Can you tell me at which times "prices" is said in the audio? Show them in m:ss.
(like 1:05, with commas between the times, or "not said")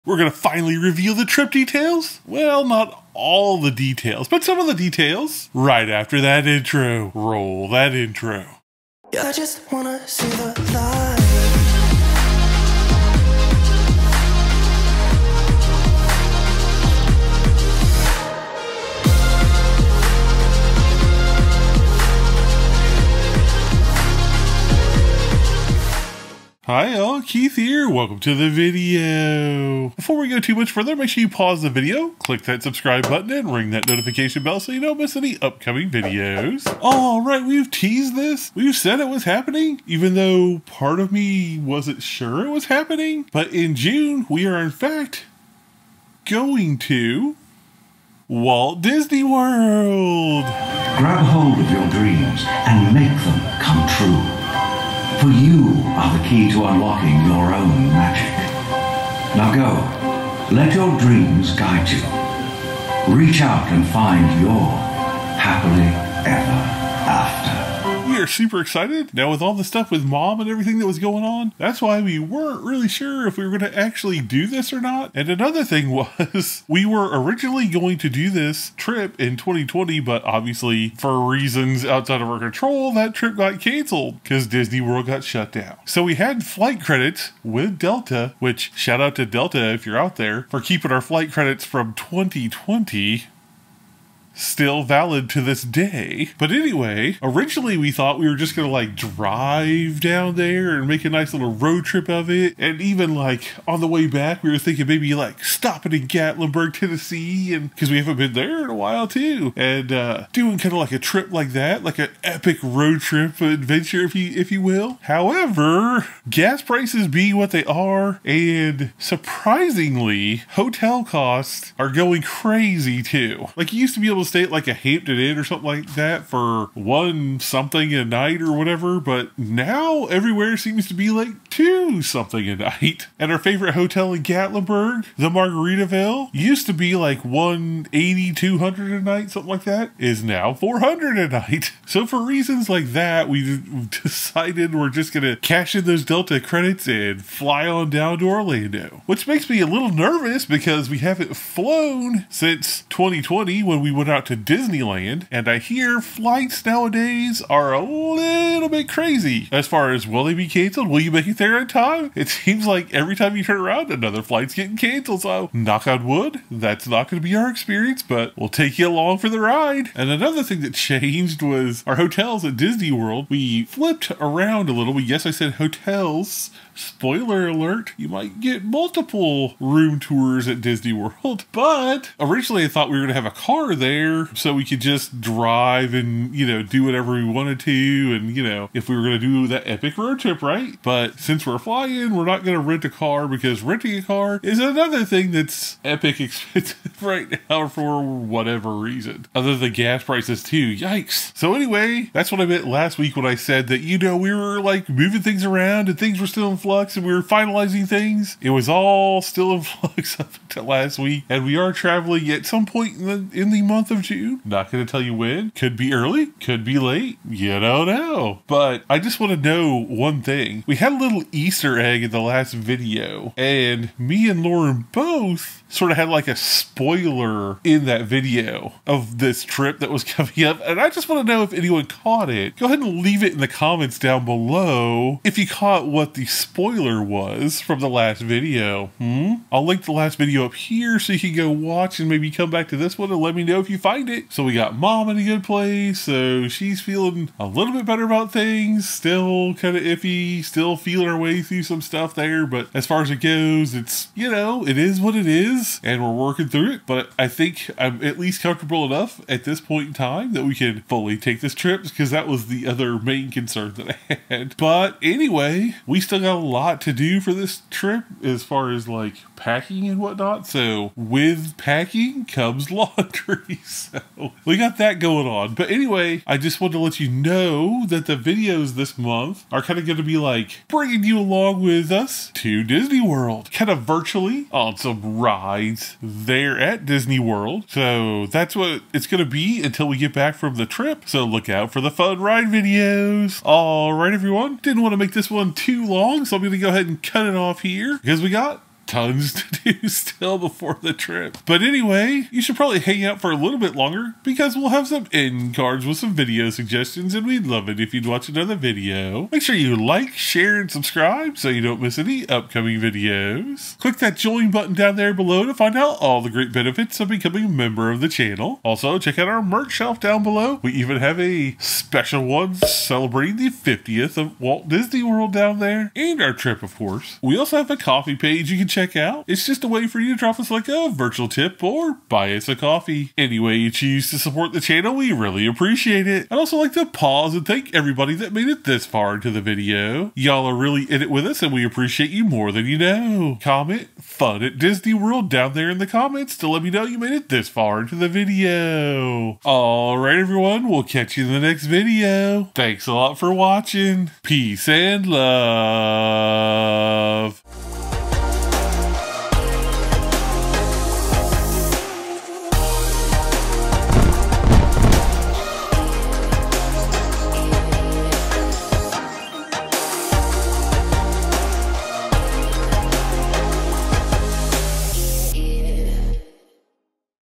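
1:56, 3:20.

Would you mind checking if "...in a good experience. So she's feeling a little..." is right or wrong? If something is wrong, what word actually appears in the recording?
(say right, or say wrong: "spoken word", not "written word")
wrong: "place", not "experience".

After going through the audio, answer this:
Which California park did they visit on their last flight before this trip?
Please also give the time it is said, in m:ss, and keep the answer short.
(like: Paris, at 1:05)
Disneyland, at 2:34.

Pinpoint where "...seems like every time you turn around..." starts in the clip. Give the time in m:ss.
2:42.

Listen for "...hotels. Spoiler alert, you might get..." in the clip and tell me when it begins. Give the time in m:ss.
2:55.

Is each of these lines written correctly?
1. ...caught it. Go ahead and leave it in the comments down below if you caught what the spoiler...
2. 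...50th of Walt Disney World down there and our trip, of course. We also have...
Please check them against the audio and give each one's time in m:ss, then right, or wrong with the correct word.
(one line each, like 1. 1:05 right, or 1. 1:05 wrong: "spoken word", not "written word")
1. 3:51 right
2. 5:23 right.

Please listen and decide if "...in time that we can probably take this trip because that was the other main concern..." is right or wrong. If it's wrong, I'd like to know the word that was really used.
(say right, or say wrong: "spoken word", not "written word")
wrong: "fully", not "probably".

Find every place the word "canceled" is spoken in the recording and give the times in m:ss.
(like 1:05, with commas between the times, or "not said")
1:23, 2:40, 2:44.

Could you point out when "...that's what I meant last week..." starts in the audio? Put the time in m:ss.
3:22.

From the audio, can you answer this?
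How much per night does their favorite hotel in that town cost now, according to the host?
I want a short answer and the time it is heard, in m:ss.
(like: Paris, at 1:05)
400, at 2:20.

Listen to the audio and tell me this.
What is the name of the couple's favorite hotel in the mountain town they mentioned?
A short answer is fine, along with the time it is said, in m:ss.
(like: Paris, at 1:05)
Margaritaville, at 2:15.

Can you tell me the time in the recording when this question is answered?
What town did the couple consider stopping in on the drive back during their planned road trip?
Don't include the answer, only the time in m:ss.
1:46.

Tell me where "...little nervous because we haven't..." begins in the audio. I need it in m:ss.
2:29.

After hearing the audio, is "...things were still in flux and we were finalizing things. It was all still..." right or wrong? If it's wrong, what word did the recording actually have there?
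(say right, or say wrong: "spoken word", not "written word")
right.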